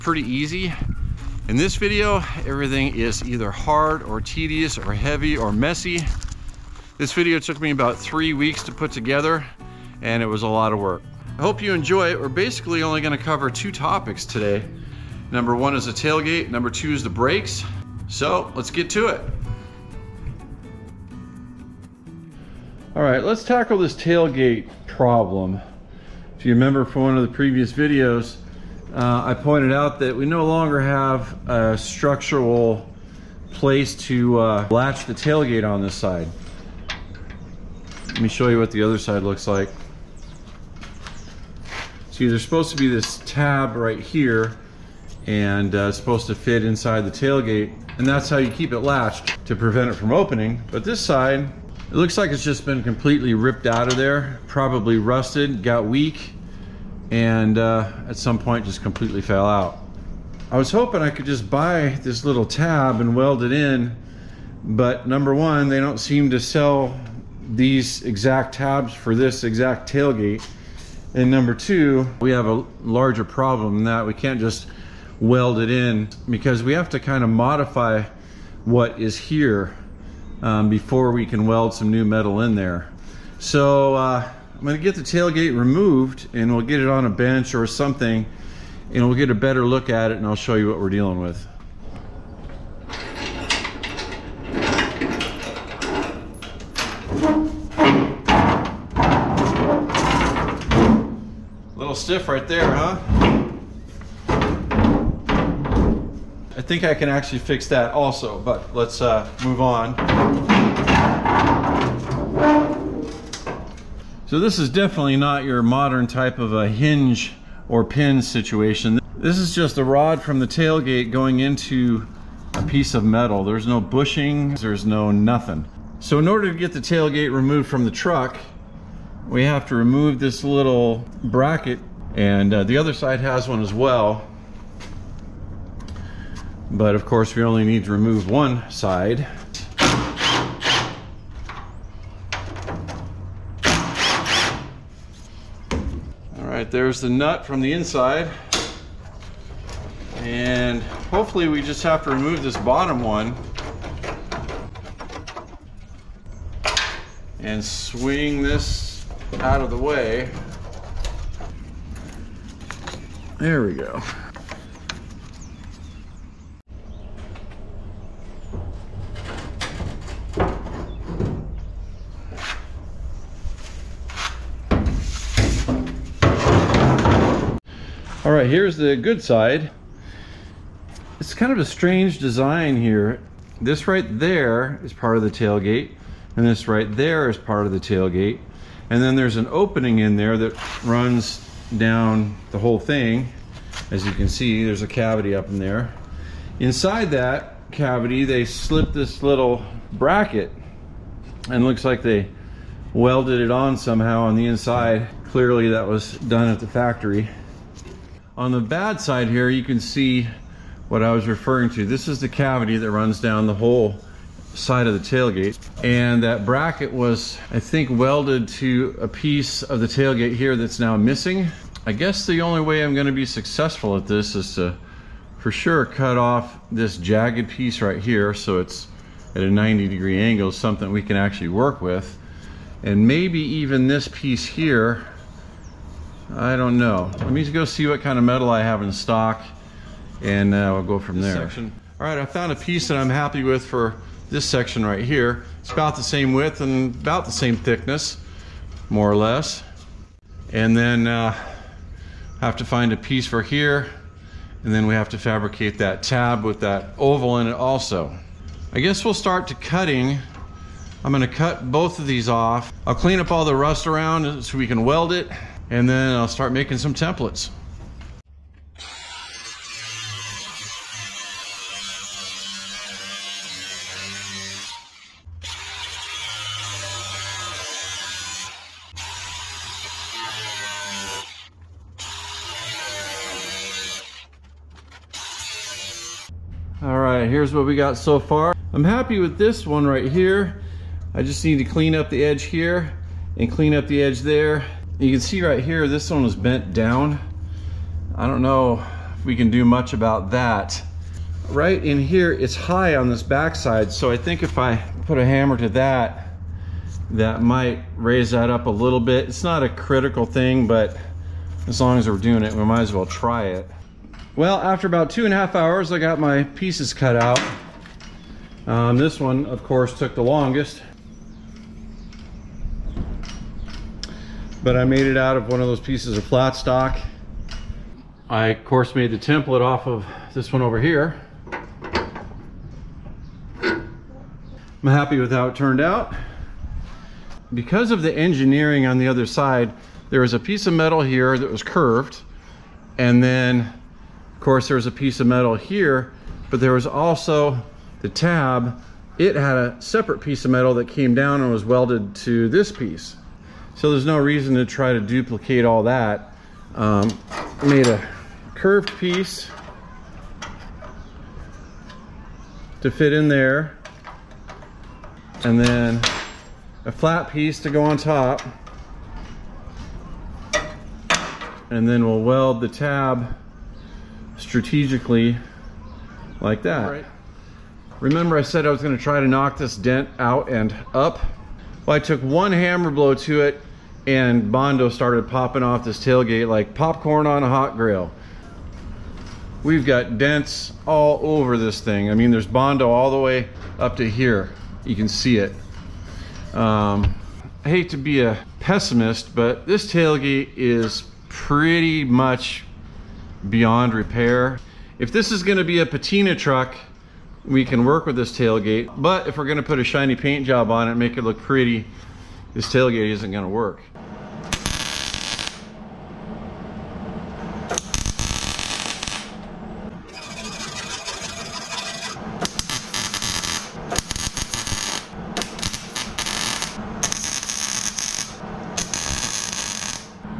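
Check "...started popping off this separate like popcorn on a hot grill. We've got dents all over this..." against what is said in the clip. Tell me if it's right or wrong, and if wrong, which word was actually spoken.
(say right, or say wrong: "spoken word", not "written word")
wrong: "tailgate", not "separate".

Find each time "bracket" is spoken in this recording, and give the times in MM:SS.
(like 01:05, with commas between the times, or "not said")
02:11, 03:19, 03:36.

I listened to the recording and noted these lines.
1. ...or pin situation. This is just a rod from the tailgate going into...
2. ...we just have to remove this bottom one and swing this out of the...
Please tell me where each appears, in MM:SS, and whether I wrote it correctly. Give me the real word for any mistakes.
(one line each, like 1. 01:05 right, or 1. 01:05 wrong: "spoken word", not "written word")
1. 01:57 right
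2. 02:31 right.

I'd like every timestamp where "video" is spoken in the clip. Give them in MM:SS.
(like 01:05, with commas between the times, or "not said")
00:01, 00:07, 00:27.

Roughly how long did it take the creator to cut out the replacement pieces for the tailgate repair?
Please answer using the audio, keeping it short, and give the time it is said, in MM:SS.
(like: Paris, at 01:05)
2.5 hours, at 05:15.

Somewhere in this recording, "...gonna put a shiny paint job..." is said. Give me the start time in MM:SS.
06:49.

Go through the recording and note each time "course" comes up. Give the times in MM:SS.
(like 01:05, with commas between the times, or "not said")
02:17, 05:19, 05:28, 05:44.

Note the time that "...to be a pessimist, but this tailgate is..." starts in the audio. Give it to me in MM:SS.
06:37.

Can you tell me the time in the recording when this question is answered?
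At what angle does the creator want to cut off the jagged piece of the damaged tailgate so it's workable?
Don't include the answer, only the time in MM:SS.
03:49.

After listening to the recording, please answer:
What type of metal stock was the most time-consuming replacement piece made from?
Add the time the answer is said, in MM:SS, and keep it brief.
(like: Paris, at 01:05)
Flat stock, at 05:26.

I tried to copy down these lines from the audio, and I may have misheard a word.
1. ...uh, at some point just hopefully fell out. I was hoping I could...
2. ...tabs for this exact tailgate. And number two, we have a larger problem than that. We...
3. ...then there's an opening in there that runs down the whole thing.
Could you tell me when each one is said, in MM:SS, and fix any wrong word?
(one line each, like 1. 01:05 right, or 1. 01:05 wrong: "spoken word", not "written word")
1. 00:57 wrong: "completely", not "hopefully"
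2. 01:08 right
3. 03:09 right.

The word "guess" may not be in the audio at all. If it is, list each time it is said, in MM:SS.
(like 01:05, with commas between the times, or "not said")
03:41, 04:18.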